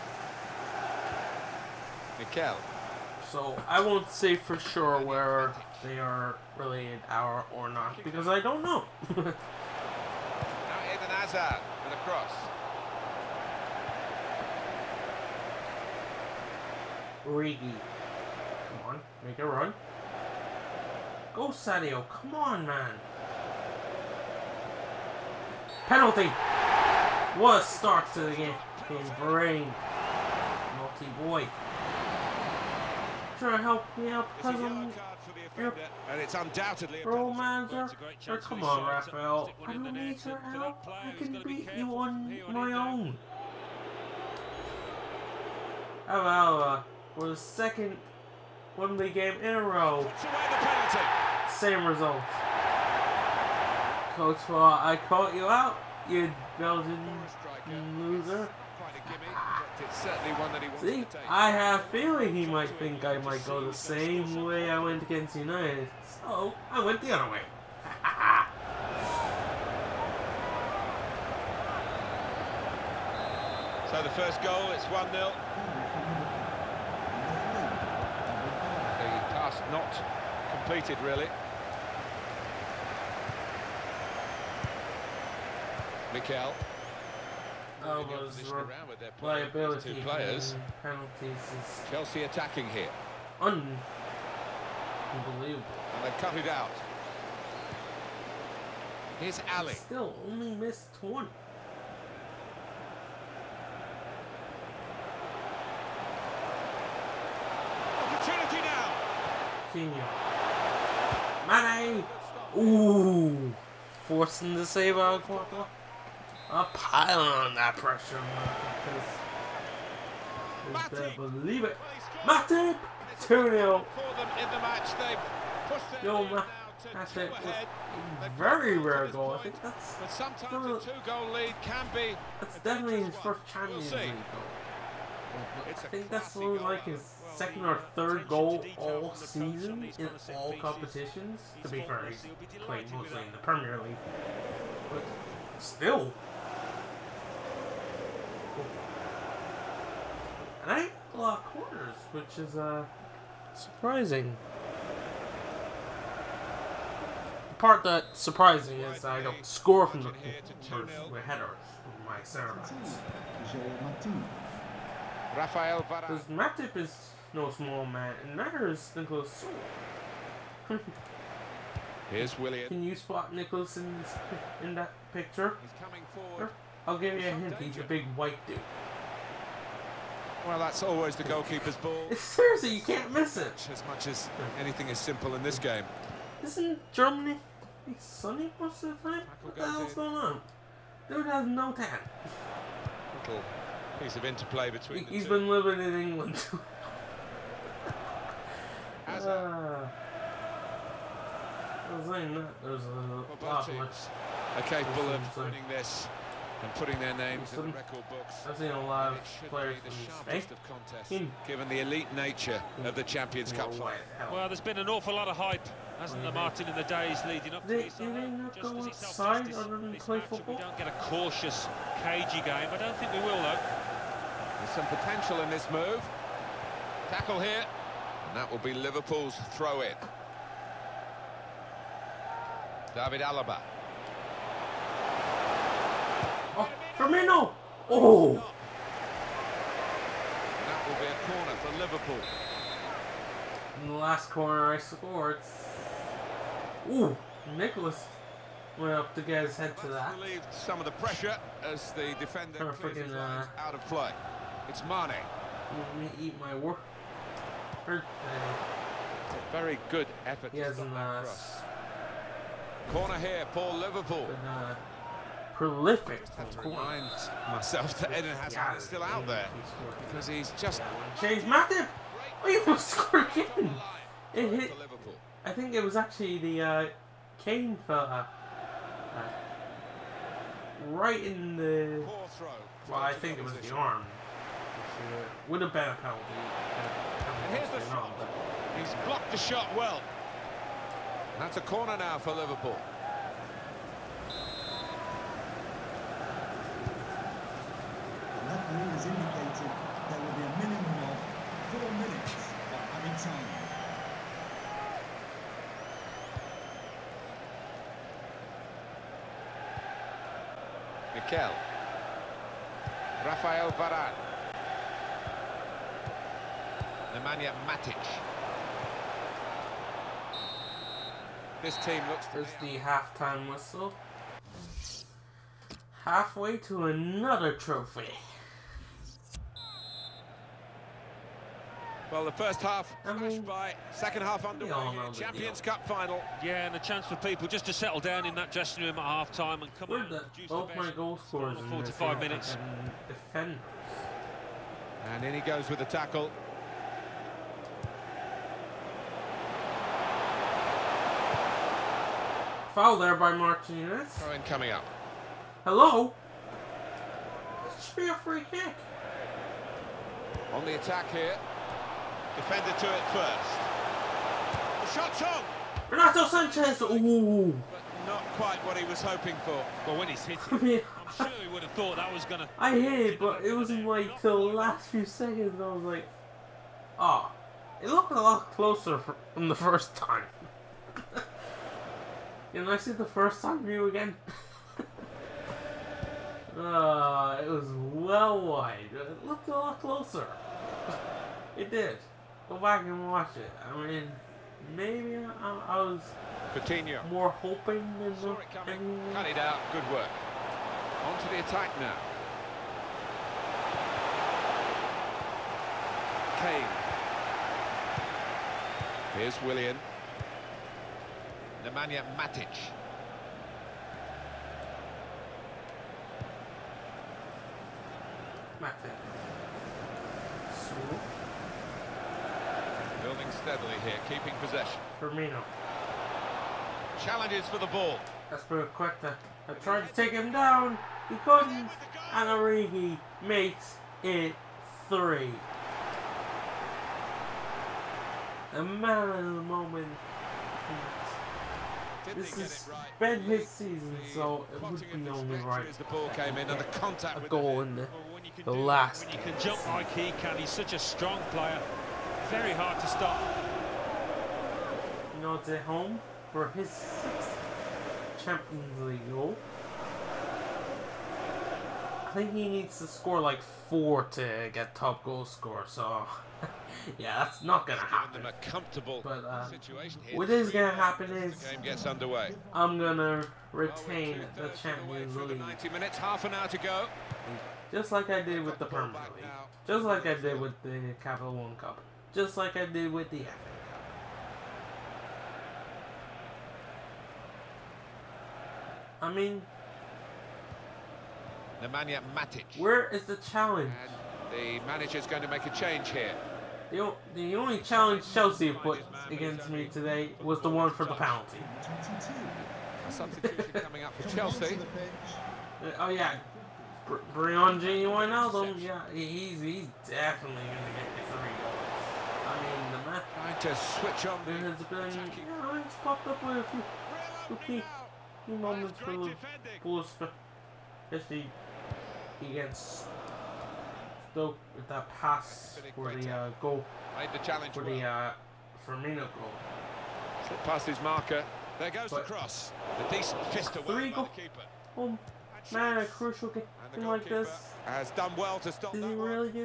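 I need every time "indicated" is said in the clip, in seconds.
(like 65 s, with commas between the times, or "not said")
299 s.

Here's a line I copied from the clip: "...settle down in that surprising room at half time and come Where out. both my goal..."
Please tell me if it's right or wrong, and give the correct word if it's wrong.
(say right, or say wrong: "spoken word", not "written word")
wrong: "dressing", not "surprising".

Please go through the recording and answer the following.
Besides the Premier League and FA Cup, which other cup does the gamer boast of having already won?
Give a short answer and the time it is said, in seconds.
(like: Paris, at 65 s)
Capital One Cup, at 481 s.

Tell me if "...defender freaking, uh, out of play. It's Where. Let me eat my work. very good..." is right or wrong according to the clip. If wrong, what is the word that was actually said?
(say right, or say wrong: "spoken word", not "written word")
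wrong: "Mane", not "Where".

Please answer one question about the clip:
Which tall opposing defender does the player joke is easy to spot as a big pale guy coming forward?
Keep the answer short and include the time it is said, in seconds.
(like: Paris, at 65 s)
Nicholas Süle, at 168 s.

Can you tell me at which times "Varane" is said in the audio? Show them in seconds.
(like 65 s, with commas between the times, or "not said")
29 s, 165 s, 313 s.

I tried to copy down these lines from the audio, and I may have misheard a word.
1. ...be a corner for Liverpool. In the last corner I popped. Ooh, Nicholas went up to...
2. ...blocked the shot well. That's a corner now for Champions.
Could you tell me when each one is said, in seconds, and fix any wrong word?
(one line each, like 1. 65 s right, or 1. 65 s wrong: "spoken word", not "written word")
1. 240 s wrong: "scored", not "popped"
2. 289 s wrong: "Liverpool", not "Champions".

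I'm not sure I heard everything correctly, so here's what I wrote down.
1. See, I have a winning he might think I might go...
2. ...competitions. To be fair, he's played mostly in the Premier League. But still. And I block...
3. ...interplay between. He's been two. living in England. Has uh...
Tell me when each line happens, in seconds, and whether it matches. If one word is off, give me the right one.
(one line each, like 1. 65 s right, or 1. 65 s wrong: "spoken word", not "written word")
1. 60 s wrong: "feeling", not "winning"
2. 140 s right
3. 194 s right.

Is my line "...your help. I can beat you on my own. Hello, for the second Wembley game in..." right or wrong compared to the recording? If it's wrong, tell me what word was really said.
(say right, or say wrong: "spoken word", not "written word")
right.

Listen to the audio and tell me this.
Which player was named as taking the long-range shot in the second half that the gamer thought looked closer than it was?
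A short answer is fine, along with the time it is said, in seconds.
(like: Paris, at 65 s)
Renato Sanchez, at 365 s.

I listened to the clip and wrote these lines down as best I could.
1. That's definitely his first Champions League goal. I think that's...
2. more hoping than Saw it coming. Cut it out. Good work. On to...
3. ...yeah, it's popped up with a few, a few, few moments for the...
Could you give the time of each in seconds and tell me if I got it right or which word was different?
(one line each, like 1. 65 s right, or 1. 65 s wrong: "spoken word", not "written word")
1. 132 s right
2. 397 s right
3. 515 s right.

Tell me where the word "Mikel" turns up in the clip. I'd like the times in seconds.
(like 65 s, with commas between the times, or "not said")
2 s, 86 s, 311 s.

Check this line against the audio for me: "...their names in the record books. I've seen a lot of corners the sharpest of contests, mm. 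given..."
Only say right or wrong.
wrong.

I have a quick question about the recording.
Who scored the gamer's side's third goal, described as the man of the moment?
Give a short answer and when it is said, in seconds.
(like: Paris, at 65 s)
Origi, at 432 s.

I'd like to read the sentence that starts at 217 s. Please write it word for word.
Did not go outside other than play football?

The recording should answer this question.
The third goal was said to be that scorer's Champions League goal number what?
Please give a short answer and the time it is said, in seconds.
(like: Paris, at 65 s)
6, at 456 s.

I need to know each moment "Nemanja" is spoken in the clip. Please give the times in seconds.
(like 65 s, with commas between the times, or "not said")
317 s, 411 s, 491 s.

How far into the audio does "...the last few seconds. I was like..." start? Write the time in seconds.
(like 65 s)
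374 s.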